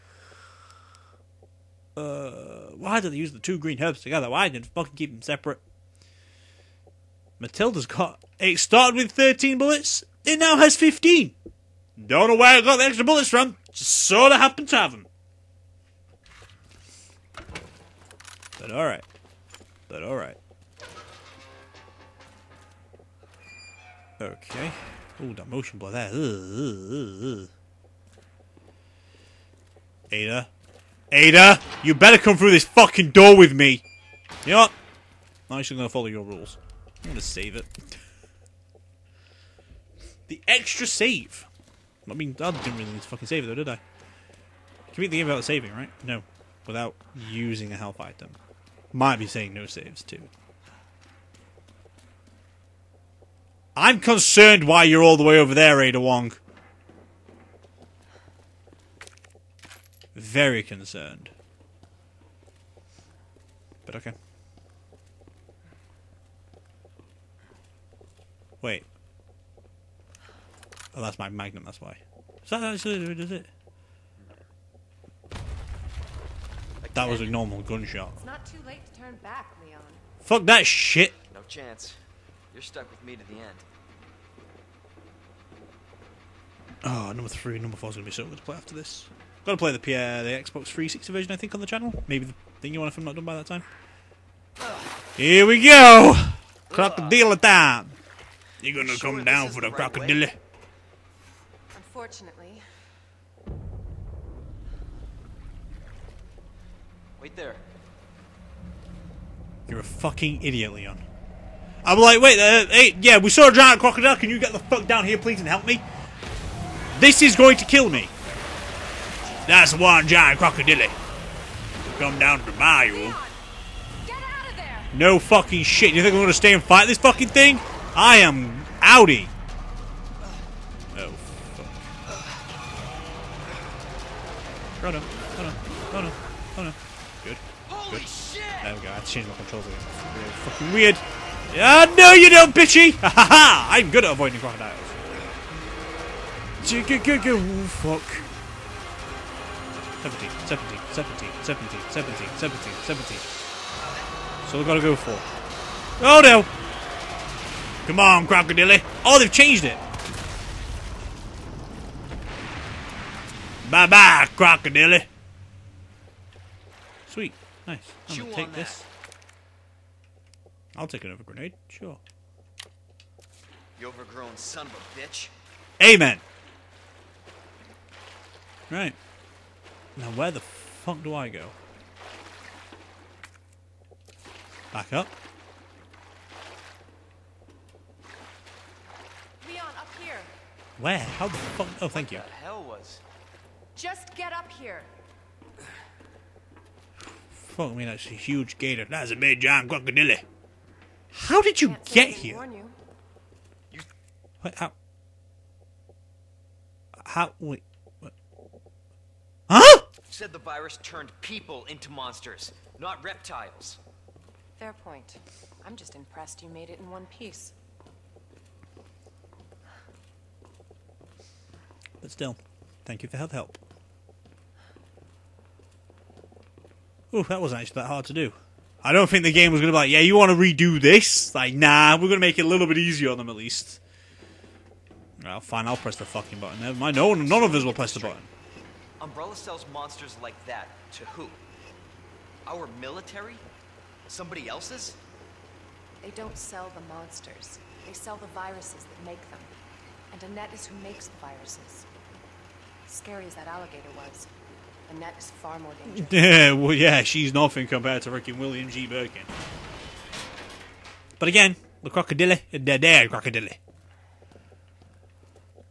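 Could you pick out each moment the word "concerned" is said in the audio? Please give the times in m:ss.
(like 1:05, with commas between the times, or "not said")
0:53, 1:00.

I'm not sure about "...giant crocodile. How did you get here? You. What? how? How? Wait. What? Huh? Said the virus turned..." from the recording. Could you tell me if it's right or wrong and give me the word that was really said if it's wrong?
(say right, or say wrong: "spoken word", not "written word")
right.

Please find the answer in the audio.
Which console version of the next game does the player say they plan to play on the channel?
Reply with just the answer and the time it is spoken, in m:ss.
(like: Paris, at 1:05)
Xbox 360, at 1:30.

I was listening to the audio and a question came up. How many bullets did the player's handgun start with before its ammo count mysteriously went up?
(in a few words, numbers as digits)
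13.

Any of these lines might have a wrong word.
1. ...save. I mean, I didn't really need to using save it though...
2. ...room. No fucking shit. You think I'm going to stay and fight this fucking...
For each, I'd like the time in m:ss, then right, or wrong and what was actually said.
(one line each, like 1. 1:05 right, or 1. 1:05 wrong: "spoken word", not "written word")
1. 0:40 wrong: "fucking", not "using"
2. 2:02 right.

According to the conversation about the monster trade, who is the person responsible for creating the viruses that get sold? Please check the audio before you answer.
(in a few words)
Annette.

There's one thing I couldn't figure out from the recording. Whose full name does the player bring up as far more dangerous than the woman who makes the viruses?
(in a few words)
William G. Birkin.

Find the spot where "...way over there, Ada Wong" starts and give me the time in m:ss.
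0:55.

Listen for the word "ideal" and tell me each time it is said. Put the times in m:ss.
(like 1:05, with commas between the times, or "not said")
not said.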